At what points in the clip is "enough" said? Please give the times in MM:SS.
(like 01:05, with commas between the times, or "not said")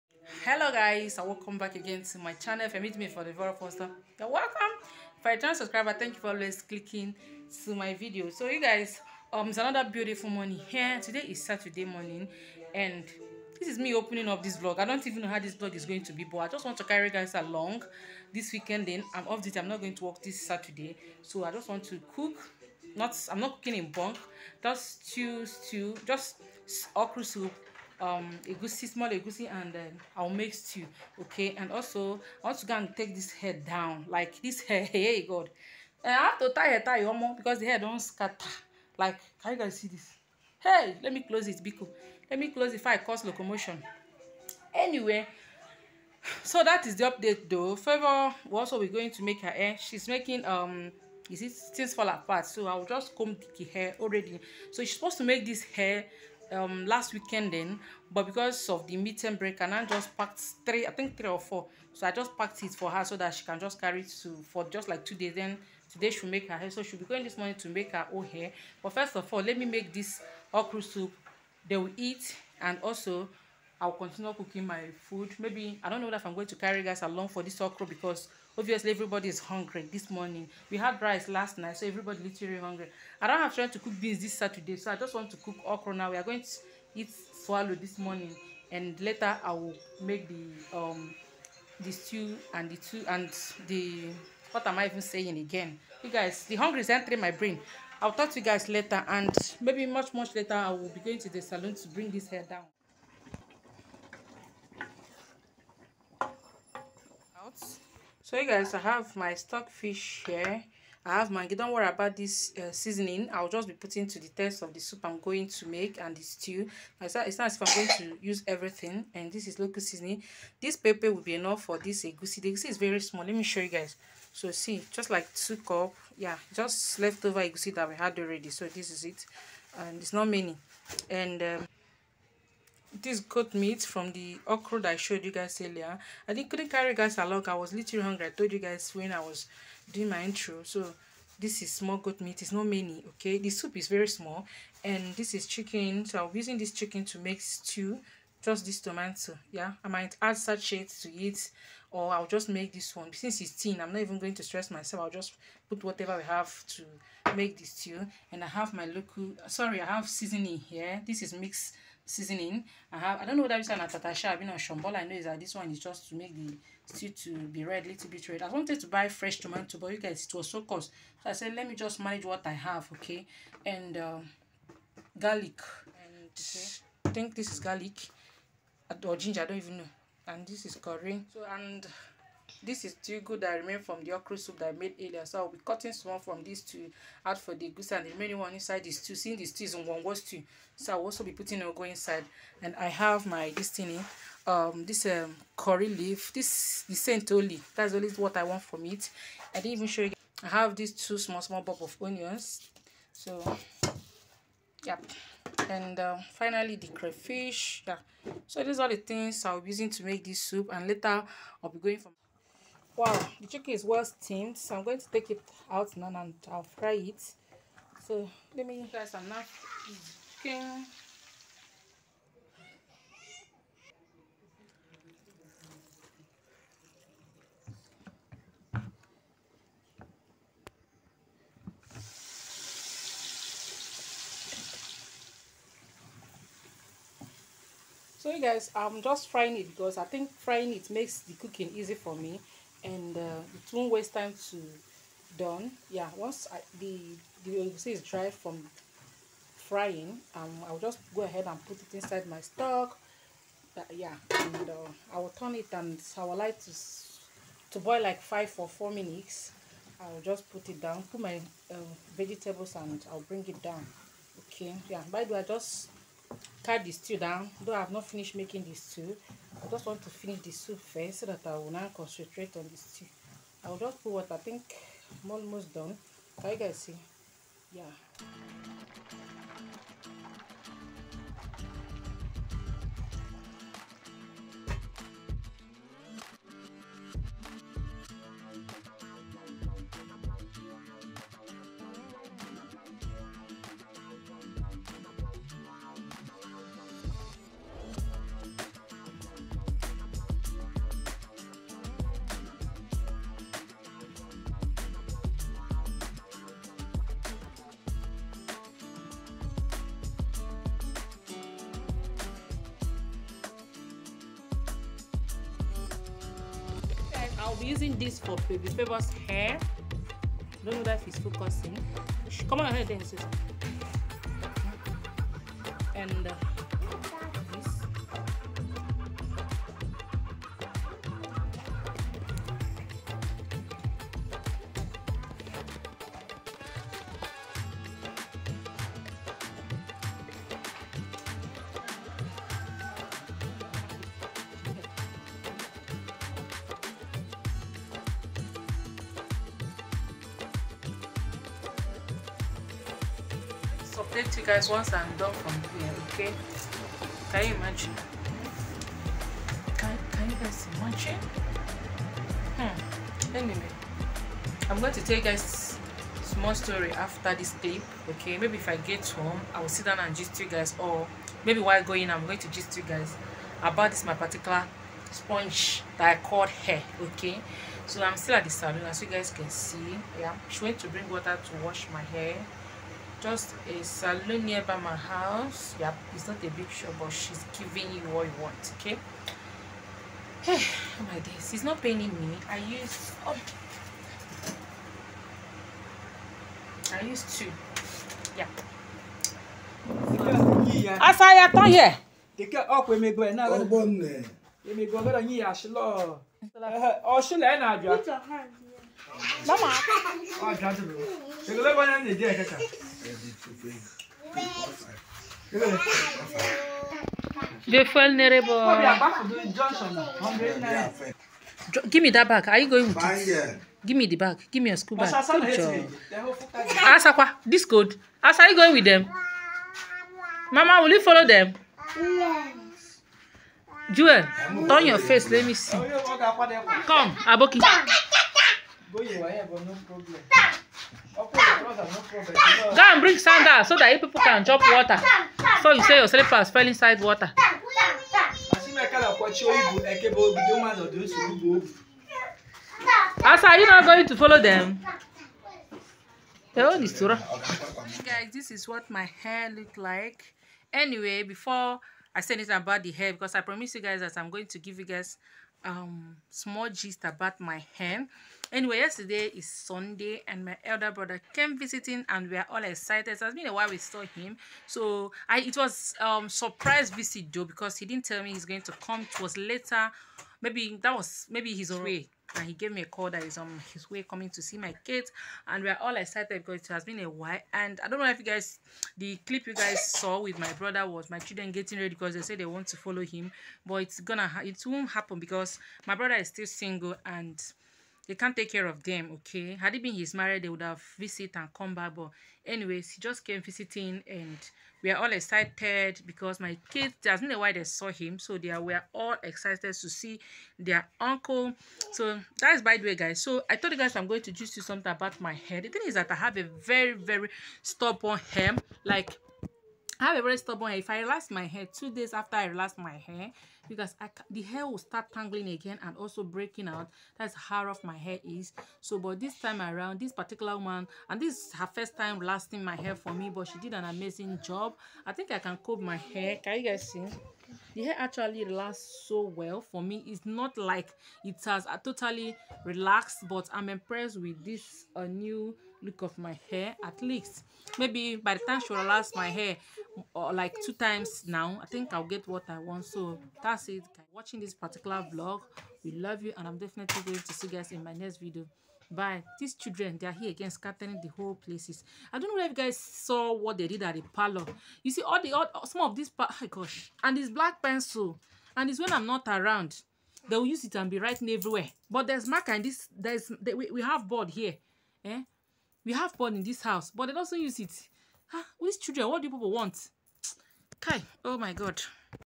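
02:01.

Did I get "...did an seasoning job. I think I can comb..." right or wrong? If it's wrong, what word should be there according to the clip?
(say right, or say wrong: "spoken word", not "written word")
wrong: "amazing", not "seasoning".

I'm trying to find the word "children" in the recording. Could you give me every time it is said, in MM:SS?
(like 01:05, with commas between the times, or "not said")
08:11, 09:19, 09:38.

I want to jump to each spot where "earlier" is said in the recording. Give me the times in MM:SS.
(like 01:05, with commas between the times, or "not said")
02:15, 03:04.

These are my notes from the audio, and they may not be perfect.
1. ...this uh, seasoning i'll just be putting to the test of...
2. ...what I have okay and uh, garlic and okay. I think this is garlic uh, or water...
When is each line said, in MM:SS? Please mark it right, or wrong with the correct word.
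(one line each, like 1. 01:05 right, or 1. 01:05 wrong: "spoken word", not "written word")
1. 01:52 right
2. 02:52 wrong: "ginger", not "water".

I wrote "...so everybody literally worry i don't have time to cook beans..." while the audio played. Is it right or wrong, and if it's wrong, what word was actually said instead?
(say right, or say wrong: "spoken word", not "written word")
wrong: "hungry", not "worry".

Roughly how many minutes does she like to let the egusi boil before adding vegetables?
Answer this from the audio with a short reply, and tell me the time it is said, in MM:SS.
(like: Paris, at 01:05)
5 or 4 minutes, at 04:18.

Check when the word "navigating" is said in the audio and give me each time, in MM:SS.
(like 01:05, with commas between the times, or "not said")
not said.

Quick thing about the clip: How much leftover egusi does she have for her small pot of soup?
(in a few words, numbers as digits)
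2 cups.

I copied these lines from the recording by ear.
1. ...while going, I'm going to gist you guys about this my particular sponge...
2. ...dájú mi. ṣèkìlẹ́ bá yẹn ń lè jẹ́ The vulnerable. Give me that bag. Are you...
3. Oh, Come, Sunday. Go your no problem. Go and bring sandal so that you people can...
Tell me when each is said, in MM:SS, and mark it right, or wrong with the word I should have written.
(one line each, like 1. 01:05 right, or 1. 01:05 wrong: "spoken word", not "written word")
1. 06:11 right
2. 06:50 right
3. 07:15 wrong: "Aboki", not "Sunday".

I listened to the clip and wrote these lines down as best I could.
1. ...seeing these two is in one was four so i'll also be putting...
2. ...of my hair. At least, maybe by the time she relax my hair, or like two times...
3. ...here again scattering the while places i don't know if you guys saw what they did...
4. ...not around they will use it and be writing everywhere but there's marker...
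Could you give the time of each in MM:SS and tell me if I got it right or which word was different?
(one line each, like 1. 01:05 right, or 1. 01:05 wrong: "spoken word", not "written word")
1. 03:09 wrong: "two", not "four"
2. 09:06 right
3. 09:20 wrong: "whole", not "while"
4. 09:29 right.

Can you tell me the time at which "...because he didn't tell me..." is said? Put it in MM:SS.
07:57.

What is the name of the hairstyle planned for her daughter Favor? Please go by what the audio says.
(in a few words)
Things Fall Apart.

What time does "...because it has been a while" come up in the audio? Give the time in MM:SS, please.
08:06.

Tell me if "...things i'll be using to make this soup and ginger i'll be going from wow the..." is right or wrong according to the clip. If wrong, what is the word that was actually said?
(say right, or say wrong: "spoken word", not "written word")
wrong: "later", not "ginger".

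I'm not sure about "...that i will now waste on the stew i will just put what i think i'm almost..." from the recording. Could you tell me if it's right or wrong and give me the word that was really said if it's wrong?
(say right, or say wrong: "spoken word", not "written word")
wrong: "concentrate", not "waste".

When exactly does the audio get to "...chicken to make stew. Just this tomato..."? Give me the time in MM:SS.
02:26.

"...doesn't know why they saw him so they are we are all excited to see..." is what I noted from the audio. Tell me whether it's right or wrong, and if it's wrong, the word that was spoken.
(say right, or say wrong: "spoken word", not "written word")
right.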